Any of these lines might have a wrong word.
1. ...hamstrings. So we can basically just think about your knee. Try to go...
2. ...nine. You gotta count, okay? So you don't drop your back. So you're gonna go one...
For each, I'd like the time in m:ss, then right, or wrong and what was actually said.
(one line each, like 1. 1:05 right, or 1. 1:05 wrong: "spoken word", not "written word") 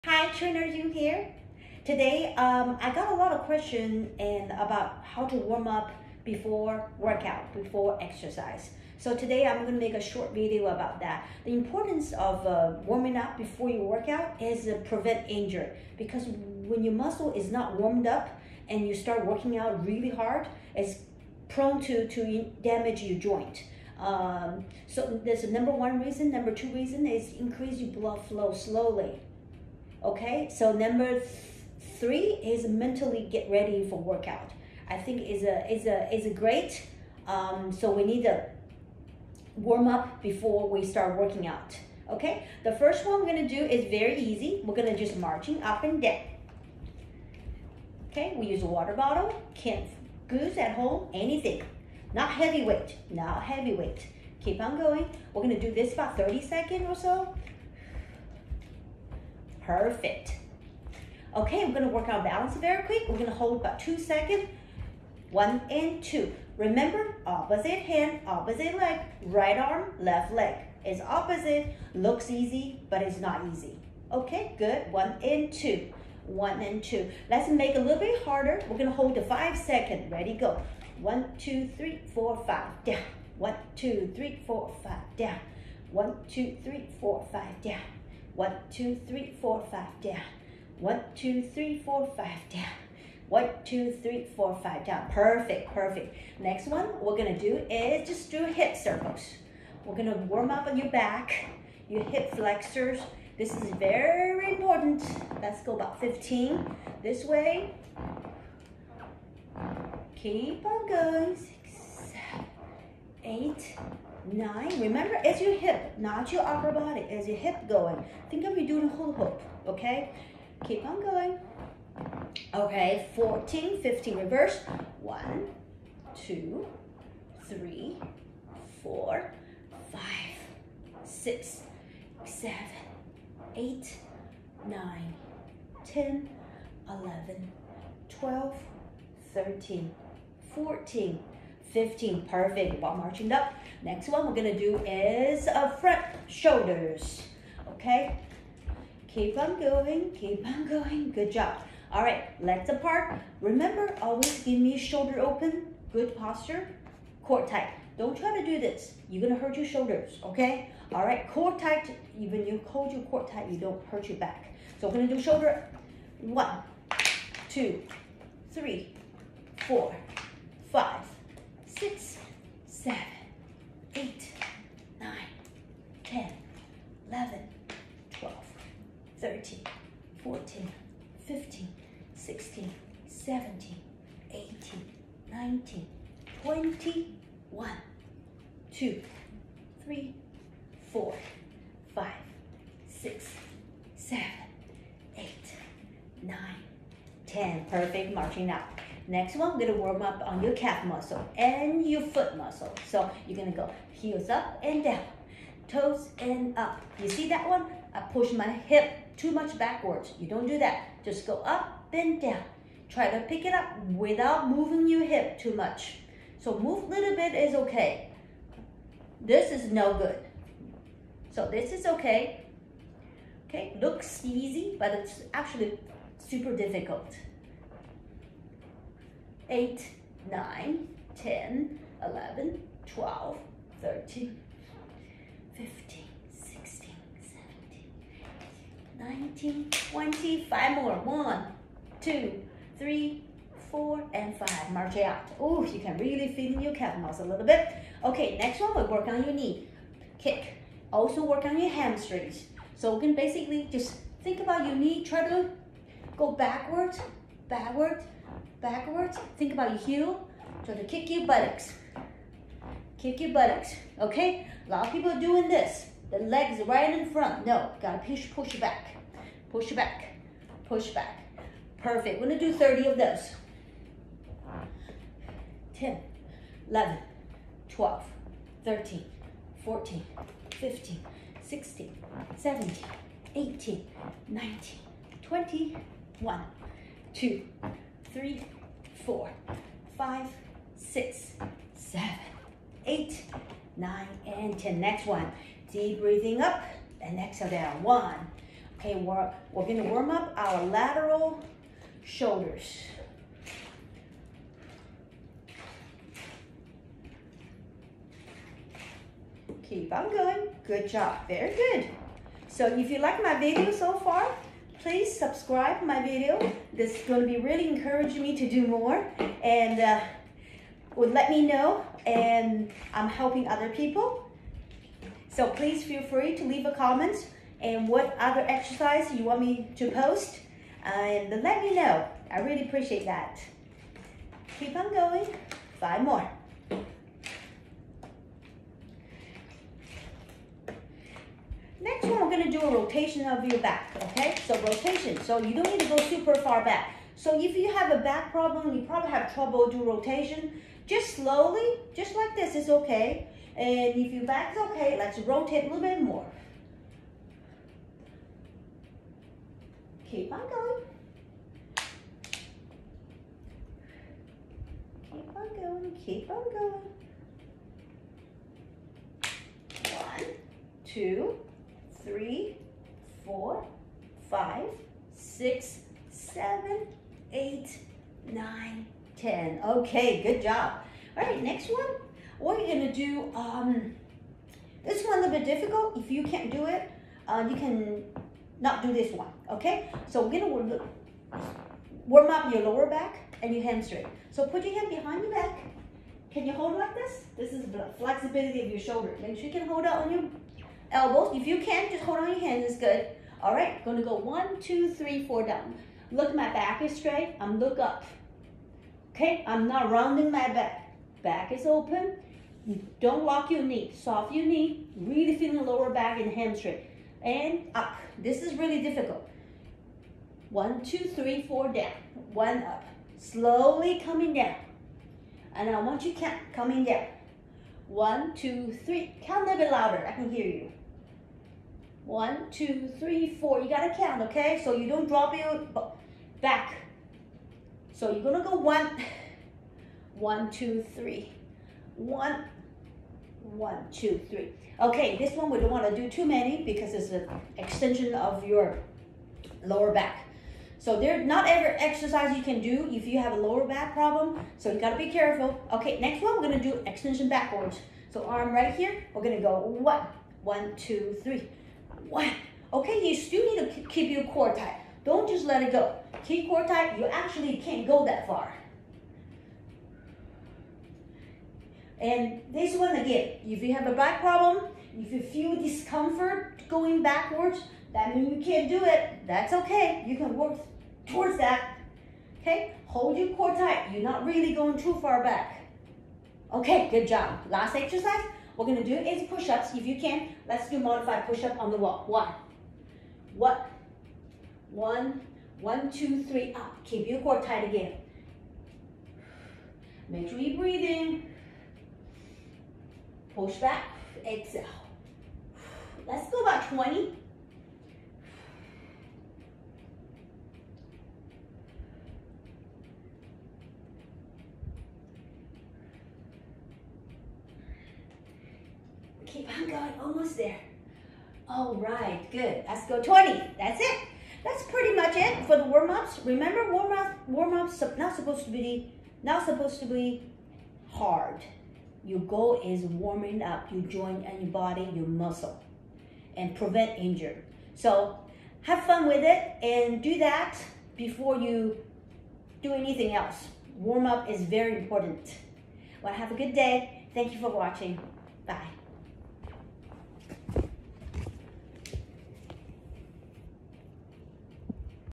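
1. 4:11 right
2. 7:13 wrong: "four", not "nine".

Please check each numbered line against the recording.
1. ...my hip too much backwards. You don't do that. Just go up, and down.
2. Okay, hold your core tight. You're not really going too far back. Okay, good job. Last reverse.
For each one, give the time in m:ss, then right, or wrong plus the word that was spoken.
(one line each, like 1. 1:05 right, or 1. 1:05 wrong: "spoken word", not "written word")
1. 3:28 right
2. 8:02 wrong: "exercise", not "reverse".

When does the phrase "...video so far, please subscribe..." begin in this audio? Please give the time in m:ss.
5:13.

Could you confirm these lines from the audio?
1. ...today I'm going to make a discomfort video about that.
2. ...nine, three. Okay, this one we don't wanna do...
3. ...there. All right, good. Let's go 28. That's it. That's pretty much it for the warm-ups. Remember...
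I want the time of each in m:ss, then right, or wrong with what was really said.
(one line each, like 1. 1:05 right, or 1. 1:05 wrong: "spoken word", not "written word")
1. 0:09 wrong: "short", not "discomfort"
2. 7:23 wrong: "two", not "nine"
3. 8:40 wrong: "20", not "28".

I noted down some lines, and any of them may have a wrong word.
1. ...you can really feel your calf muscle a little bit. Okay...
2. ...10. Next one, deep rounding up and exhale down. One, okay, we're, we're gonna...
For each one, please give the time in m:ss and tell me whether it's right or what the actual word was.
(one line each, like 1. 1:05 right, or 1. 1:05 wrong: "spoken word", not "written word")
1. 4:05 right
2. 4:54 wrong: "breathing", not "rounding".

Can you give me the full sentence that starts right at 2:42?
Even you hold your core tight, you don't hurt your back.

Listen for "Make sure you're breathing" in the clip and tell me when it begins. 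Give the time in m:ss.
8:20.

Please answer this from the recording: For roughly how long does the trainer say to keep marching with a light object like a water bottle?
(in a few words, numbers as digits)
30 seconds.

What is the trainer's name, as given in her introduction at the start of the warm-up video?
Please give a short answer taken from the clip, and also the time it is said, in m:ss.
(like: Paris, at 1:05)
June, at 0:00.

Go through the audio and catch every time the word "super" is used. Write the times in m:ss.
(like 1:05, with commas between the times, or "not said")
3:46, 5:45.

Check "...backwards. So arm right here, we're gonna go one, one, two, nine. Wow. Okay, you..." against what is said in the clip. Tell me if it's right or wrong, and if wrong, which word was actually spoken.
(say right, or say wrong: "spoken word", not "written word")
wrong: "three", not "nine".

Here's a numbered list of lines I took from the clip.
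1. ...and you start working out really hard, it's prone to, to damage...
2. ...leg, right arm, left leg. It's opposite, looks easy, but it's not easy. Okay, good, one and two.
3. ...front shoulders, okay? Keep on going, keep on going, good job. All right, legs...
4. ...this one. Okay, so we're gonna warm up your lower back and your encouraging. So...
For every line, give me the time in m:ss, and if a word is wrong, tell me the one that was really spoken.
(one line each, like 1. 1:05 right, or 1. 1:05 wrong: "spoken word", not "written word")
1. 0:18 right
2. 1:08 right
3. 2:25 right
4. 6:28 wrong: "hamstring", not "encouraging".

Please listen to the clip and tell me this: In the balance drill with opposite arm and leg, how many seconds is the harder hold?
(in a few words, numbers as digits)
5.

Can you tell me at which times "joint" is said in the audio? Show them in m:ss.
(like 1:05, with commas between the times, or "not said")
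0:23, 8:53.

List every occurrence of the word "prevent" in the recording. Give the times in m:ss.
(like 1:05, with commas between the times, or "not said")
0:14, 8:56.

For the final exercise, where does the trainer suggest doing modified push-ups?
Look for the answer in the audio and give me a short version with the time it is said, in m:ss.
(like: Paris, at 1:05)
on the wall, at 8:11.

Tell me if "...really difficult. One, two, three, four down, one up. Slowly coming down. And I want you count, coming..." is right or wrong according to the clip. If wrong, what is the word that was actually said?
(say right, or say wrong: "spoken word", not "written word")
right.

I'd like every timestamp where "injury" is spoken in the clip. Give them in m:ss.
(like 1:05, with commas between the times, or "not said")
0:15, 8:56.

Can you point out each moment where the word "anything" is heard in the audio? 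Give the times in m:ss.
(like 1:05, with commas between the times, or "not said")
0:51, 9:02.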